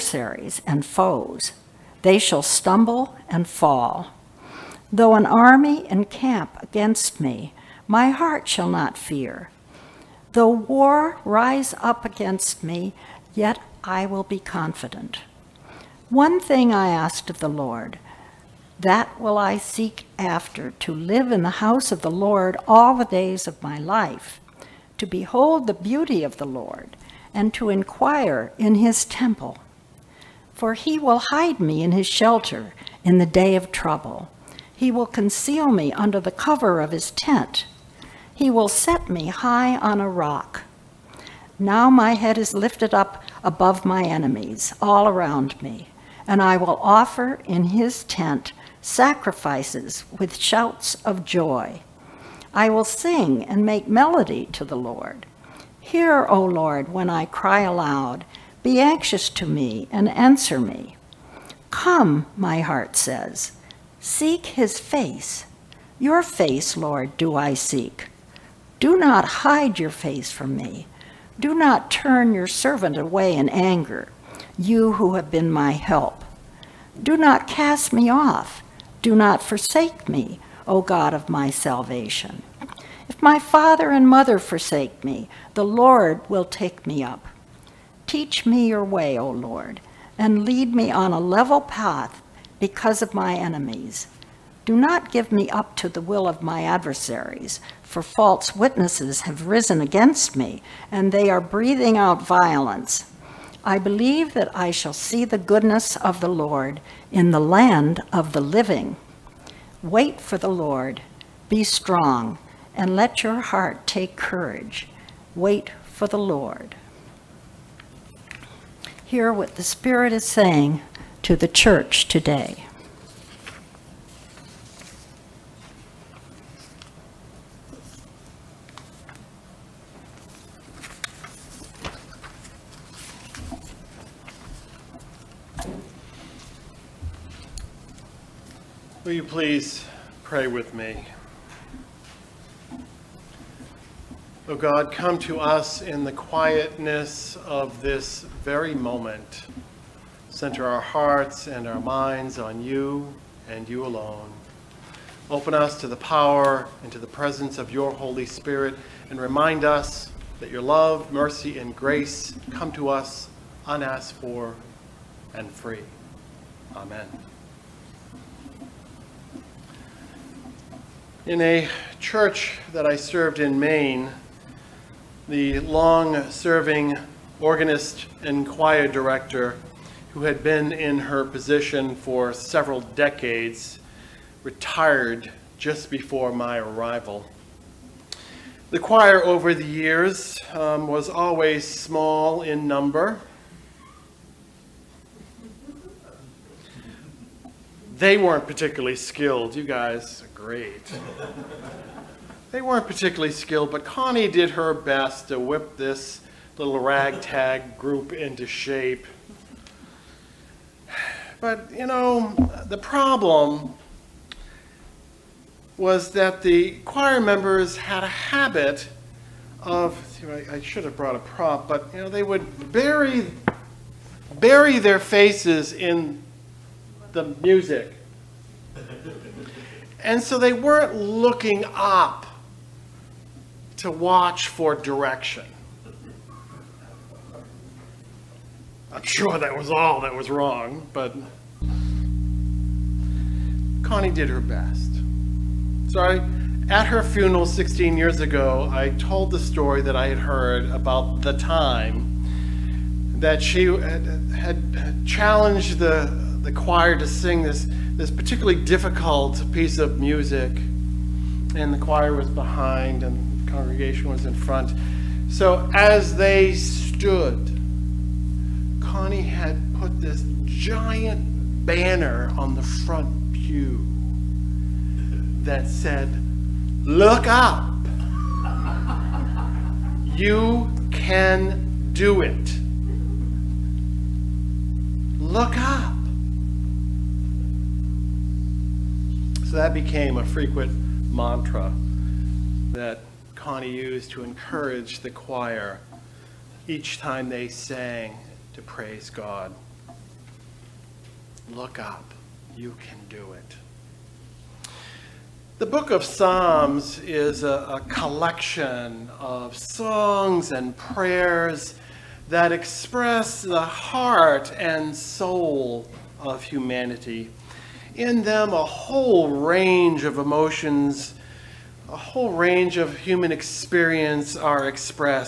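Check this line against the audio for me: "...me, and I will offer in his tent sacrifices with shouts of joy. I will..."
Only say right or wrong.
right.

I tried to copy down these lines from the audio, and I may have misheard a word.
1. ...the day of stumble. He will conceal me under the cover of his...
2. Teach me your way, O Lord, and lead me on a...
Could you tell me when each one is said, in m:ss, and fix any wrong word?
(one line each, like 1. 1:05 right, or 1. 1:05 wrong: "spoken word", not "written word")
1. 0:33 wrong: "trouble", not "stumble"
2. 1:28 right.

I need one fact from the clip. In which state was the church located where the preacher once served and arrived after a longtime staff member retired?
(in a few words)
Maine.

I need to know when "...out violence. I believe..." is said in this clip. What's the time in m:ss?
1:41.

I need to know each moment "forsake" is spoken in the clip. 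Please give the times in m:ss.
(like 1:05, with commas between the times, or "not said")
1:19, 1:24.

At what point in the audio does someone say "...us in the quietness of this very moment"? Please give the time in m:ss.
2:25.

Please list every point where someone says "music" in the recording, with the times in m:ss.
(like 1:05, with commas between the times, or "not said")
3:47, 4:19.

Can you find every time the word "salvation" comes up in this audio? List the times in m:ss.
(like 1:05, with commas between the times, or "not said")
1:21.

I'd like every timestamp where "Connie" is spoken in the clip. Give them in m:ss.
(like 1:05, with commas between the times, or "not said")
3:23, 4:03, 4:28, 4:53.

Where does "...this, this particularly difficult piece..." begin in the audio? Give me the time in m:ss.
4:17.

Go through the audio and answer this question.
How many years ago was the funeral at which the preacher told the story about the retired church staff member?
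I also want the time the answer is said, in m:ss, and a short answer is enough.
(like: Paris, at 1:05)
16, at 4:07.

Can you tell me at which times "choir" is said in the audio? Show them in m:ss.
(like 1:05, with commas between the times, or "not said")
2:58, 3:08, 3:36, 4:16, 4:21, 4:55.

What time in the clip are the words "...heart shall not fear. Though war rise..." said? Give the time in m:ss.
0:08.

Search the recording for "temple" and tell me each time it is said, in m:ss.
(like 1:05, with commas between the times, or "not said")
0:29.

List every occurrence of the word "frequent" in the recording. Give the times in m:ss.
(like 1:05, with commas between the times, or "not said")
4:50.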